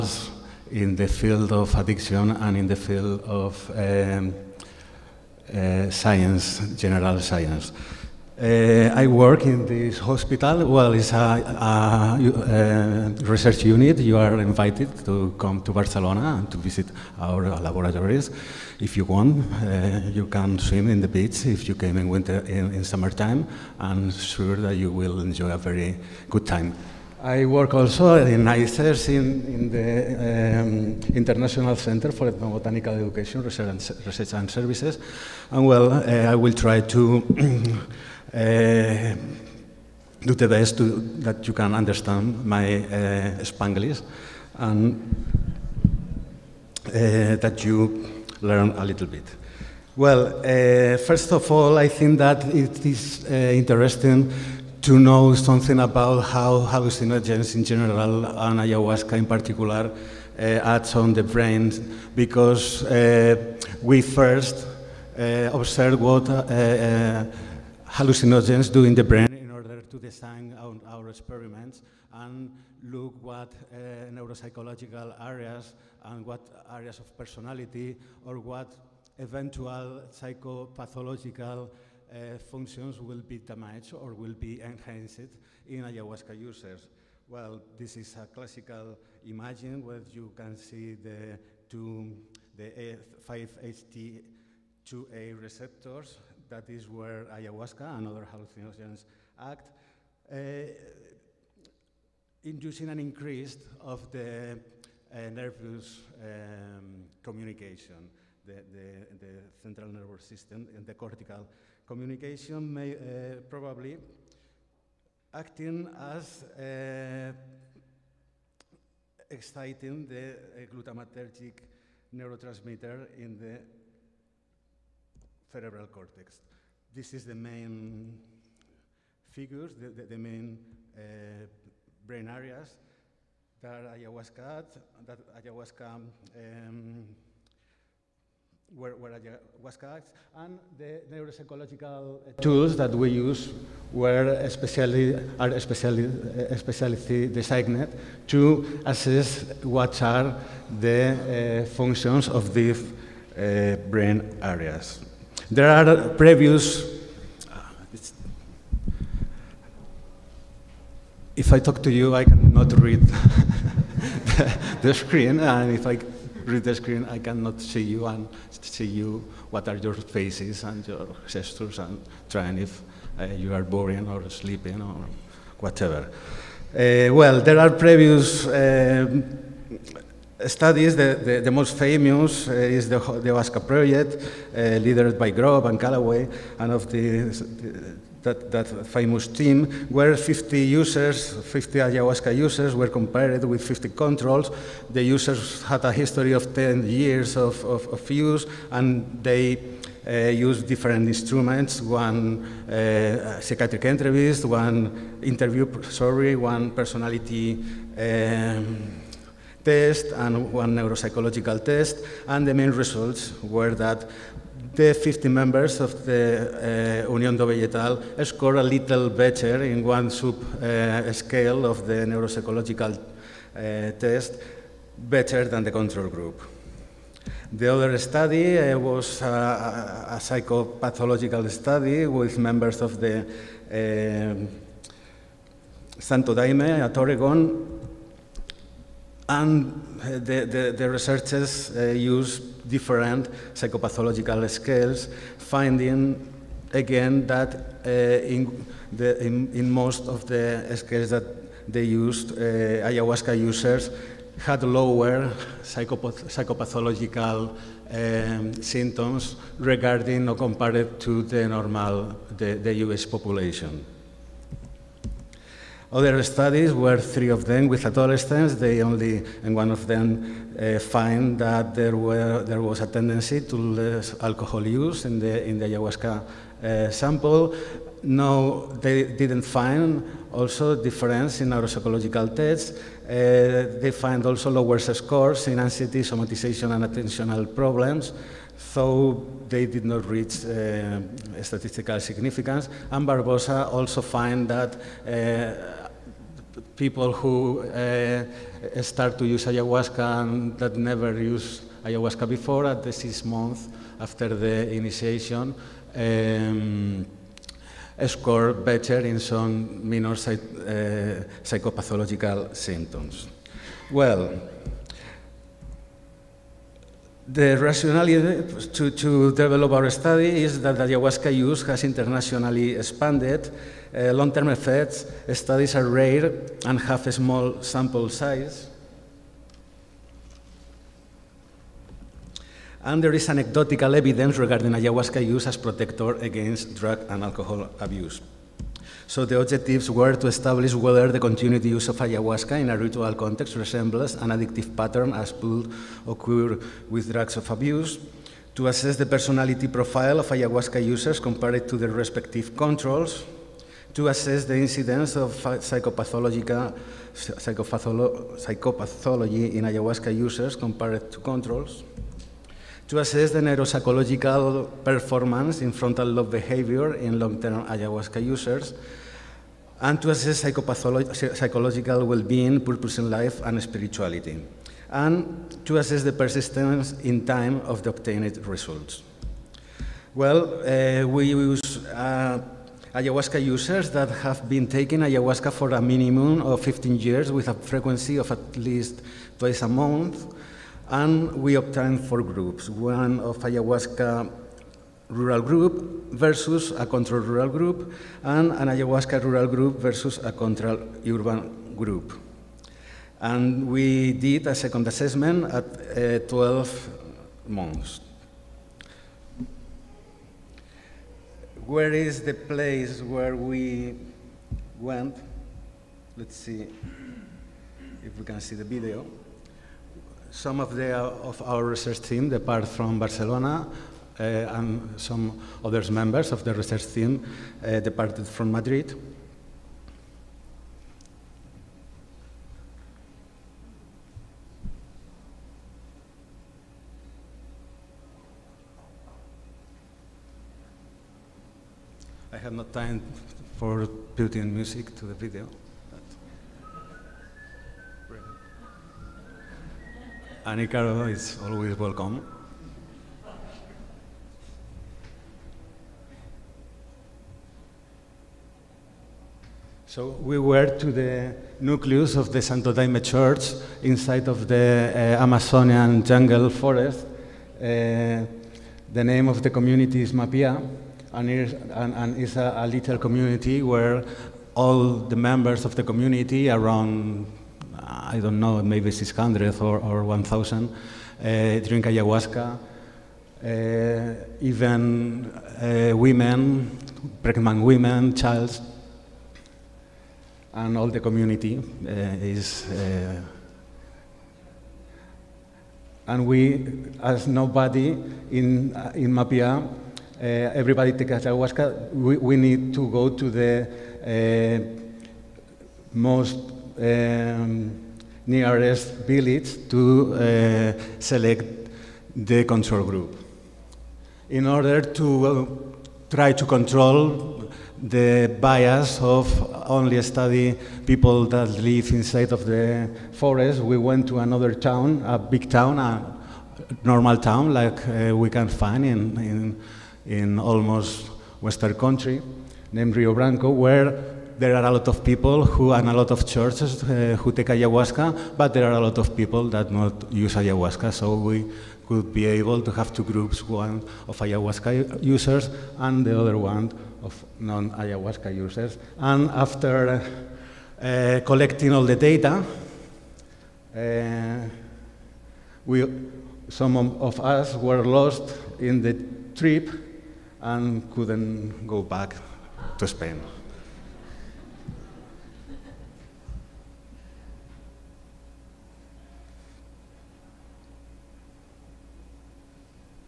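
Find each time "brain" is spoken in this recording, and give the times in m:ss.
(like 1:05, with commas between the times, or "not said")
1:01, 1:09, 2:12, 2:33.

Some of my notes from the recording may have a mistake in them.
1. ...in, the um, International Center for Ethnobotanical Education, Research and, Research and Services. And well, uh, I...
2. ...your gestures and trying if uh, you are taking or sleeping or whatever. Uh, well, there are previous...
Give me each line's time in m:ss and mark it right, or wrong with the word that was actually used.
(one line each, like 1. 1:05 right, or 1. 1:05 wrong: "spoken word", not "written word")
1. 0:29 right
2. 2:50 wrong: "boring", not "taking".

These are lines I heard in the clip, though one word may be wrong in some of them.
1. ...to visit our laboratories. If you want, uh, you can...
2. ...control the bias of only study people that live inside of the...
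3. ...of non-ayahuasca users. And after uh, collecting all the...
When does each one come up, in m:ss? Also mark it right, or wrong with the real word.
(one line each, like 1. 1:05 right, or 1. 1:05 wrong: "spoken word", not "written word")
1. 0:16 right
2. 8:36 right
3. 9:07 right.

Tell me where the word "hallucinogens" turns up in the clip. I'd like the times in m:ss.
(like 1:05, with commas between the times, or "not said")
0:56, 1:07, 1:38.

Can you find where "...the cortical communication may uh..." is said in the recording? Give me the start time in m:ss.
1:50.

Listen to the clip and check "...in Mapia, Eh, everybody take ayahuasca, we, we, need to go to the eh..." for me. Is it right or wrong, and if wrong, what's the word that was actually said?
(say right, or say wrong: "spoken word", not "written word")
right.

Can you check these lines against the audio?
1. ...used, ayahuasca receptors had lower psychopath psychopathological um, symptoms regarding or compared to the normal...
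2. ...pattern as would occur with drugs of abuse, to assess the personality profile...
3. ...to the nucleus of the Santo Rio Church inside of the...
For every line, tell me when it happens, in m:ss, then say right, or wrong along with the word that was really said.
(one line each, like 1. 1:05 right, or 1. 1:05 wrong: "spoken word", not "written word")
1. 4:11 wrong: "users", not "receptors"
2. 5:44 right
3. 7:40 wrong: "Daime", not "Rio".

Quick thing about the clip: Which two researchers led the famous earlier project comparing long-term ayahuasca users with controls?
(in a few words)
Grob and Callaway.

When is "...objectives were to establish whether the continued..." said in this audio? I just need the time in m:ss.
5:39.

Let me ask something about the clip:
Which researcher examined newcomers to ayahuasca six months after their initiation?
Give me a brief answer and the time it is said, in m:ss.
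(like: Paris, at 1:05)
Barbosa, at 4:53.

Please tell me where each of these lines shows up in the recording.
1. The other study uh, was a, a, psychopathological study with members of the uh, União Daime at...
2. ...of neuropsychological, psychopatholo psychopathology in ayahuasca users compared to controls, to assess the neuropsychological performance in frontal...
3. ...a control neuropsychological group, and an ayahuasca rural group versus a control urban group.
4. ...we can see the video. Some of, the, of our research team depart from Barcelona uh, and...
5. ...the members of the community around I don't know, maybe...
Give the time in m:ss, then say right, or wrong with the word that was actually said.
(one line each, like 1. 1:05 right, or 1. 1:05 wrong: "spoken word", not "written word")
1. 3:47 wrong: "Santo", not "União"
2. 5:55 wrong: "psychopathological", not "neuropsychological"
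3. 6:36 wrong: "rural", not "neuropsychological"
4. 6:58 right
5. 7:54 right.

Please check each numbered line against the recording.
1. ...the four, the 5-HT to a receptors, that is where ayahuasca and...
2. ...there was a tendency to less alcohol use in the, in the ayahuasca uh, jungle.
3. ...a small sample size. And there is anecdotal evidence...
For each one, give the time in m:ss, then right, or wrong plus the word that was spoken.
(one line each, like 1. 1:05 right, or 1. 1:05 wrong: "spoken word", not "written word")
1. 1:30 wrong: "two", not "four"
2. 4:32 wrong: "sample", not "jungle"
3. 5:27 right.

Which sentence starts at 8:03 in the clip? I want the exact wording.
Uh, even uh, women, pregnant women, children, and all the community uh, is.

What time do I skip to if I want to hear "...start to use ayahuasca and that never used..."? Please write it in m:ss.
4:58.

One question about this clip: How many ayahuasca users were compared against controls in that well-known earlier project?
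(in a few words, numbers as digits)
50.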